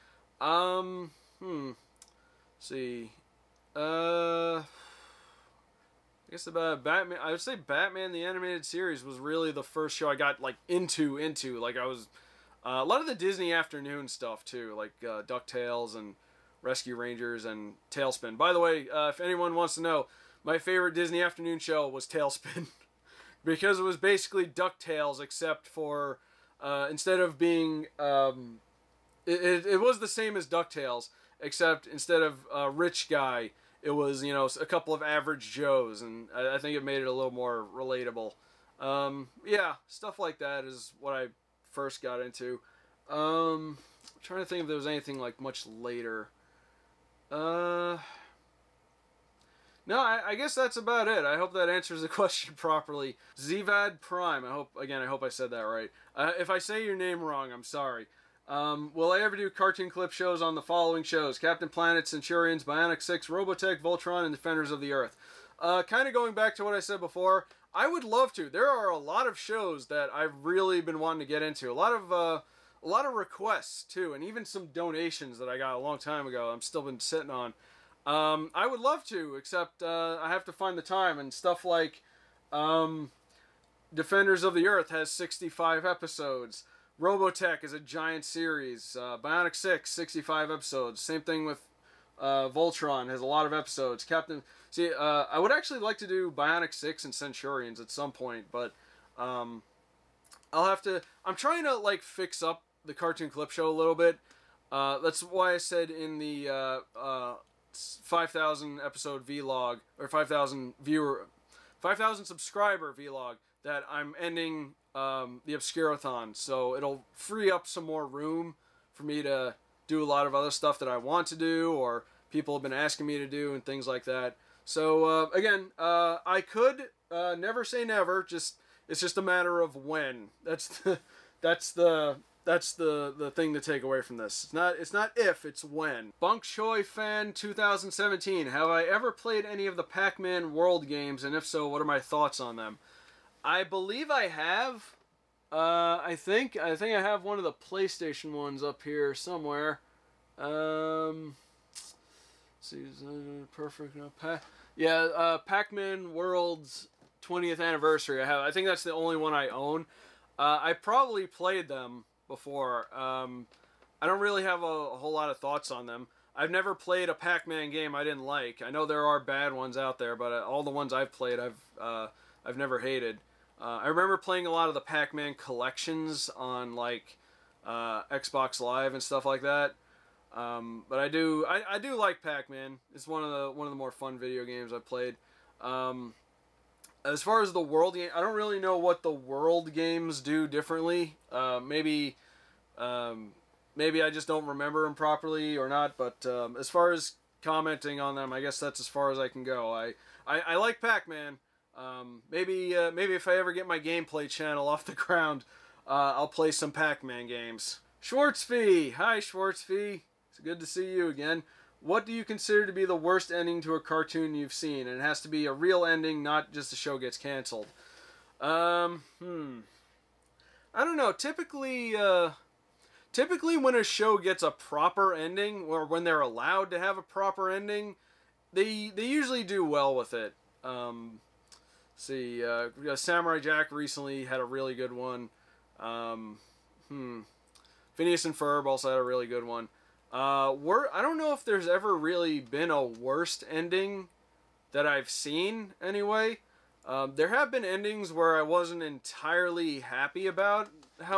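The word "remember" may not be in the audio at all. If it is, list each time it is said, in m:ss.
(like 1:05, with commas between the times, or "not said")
2:53, 3:14.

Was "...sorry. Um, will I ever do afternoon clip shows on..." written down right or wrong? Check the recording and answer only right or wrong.
wrong.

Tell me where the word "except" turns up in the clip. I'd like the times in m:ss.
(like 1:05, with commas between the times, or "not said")
0:25, 0:31, 1:19.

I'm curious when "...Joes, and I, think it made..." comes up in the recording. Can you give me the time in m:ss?
0:35.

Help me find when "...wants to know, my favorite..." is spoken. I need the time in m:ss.
0:19.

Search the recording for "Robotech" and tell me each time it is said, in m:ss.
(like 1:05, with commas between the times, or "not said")
1:03, 1:27.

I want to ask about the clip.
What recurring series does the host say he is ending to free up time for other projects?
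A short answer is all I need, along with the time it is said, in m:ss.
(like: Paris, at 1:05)
the Obscurathon, at 1:55.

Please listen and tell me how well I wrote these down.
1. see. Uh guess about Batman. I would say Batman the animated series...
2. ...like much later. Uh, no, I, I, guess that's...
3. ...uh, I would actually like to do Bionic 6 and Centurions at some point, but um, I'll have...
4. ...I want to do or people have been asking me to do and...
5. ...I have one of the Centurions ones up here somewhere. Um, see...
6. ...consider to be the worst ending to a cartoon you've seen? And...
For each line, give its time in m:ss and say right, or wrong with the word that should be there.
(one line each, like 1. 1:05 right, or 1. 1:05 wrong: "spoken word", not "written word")
1. 0:02 right
2. 0:45 right
3. 1:34 right
4. 2:00 right
5. 2:26 wrong: "PlayStation", not "Centurions"
6. 3:32 right.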